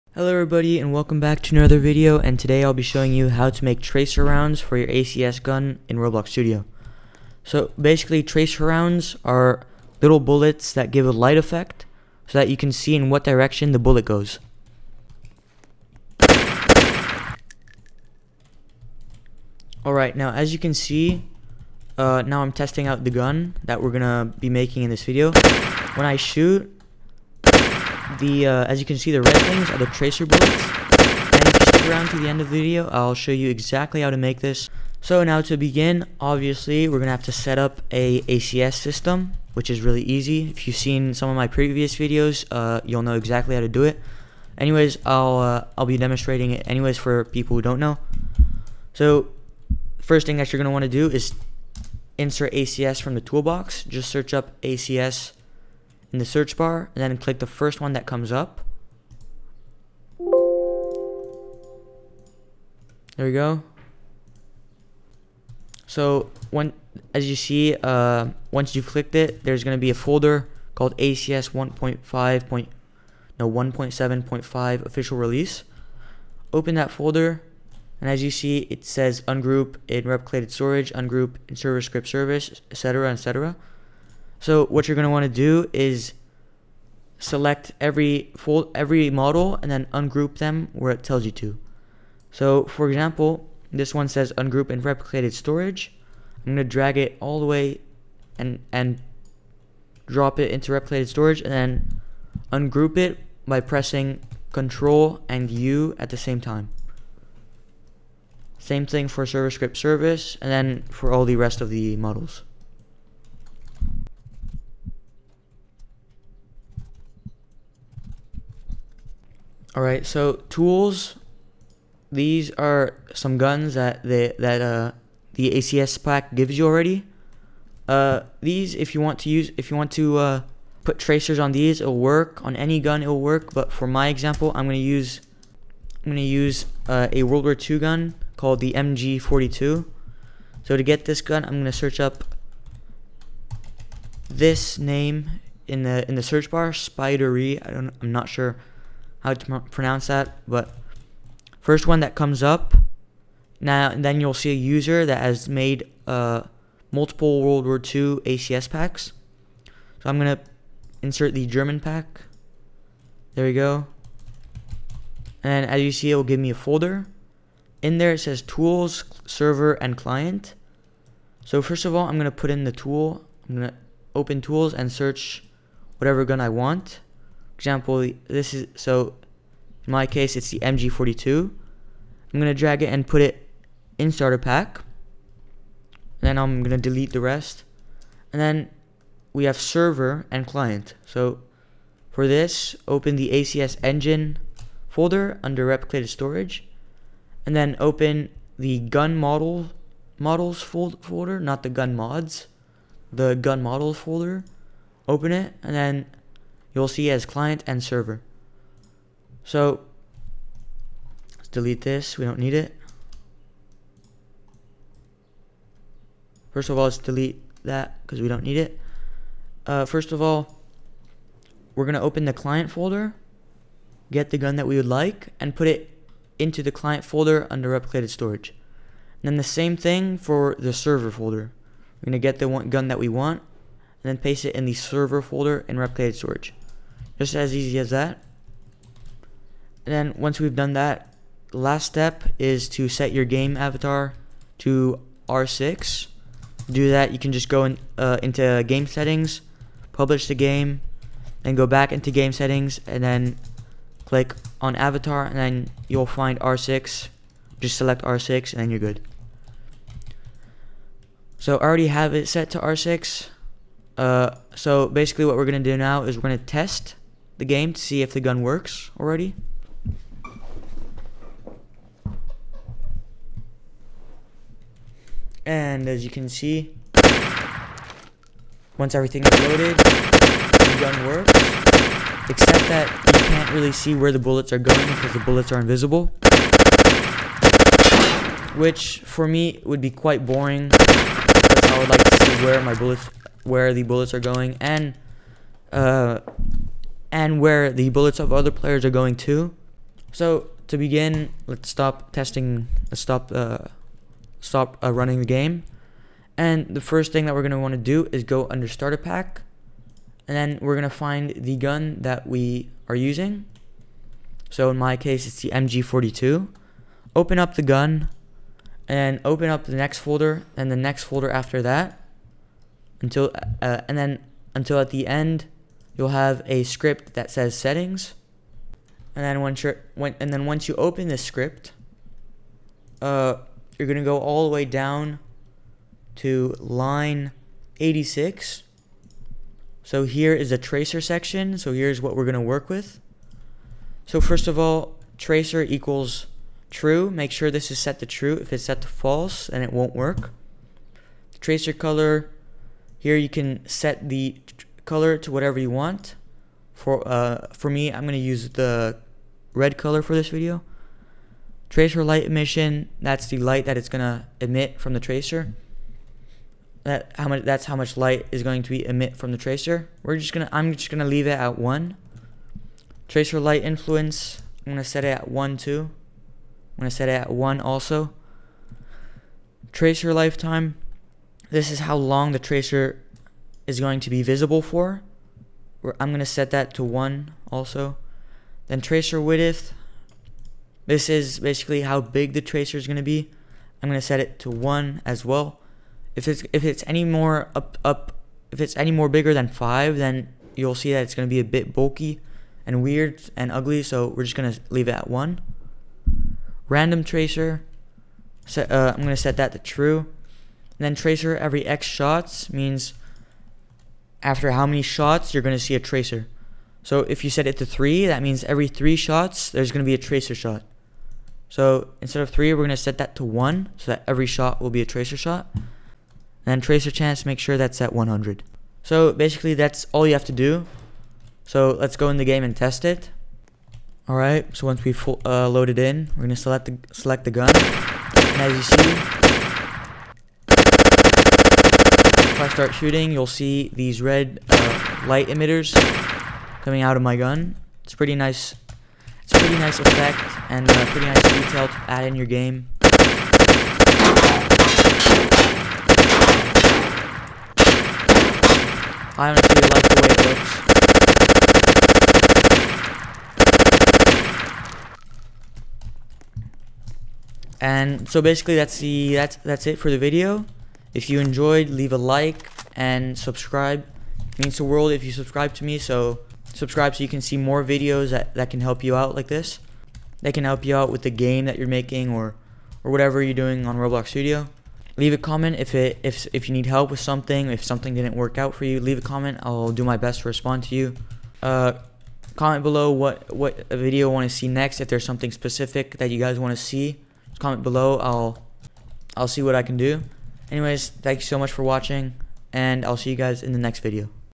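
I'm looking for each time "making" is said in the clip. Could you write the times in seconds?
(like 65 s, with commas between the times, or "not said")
24 s, 481 s.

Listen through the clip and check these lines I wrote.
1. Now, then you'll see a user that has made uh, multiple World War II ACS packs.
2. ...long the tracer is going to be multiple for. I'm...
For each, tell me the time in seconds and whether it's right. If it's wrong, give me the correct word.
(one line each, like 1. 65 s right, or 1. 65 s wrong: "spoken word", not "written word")
1. 153 s right
2. 381 s wrong: "visible", not "multiple".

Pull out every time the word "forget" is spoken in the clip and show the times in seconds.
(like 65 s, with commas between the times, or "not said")
not said.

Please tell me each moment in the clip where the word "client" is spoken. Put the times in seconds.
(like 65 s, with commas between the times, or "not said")
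169 s, 190 s, 207 s, 222 s, 226 s.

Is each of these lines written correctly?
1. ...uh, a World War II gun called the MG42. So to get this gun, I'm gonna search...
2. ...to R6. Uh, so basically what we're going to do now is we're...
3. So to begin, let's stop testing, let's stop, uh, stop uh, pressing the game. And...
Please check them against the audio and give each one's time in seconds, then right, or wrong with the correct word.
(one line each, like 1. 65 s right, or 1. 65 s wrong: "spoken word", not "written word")
1. 136 s right
2. 262 s right
3. 300 s wrong: "running", not "pressing".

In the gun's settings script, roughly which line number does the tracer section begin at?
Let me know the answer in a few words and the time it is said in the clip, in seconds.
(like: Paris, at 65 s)
86, at 336 s.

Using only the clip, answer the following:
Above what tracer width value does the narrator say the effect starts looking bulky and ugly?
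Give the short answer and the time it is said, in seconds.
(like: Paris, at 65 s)
5, at 399 s.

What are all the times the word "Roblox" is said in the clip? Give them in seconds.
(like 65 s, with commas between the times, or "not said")
5 s, 483 s.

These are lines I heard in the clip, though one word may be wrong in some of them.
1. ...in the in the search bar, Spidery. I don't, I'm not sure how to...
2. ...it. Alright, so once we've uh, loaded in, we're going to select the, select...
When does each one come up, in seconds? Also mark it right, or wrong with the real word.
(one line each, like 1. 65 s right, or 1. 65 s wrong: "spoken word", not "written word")
1. 145 s right
2. 432 s right.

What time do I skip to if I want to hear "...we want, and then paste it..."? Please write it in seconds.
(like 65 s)
232 s.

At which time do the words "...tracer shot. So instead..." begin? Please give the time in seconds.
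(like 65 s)
419 s.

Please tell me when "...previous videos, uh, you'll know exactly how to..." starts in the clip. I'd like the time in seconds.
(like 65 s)
41 s.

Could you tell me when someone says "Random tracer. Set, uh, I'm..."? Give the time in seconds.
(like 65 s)
406 s.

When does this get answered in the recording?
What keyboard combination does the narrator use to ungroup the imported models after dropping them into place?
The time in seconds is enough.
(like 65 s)
104 s.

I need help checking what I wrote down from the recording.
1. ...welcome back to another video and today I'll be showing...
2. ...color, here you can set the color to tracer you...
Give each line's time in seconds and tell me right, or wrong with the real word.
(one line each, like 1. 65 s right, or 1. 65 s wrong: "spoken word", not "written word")
1. 0 s right
2. 351 s wrong: "whatever", not "tracer".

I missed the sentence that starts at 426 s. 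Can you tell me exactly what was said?
And tracer chance, make sure that's at 100.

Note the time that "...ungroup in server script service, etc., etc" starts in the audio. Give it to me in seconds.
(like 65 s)
80 s.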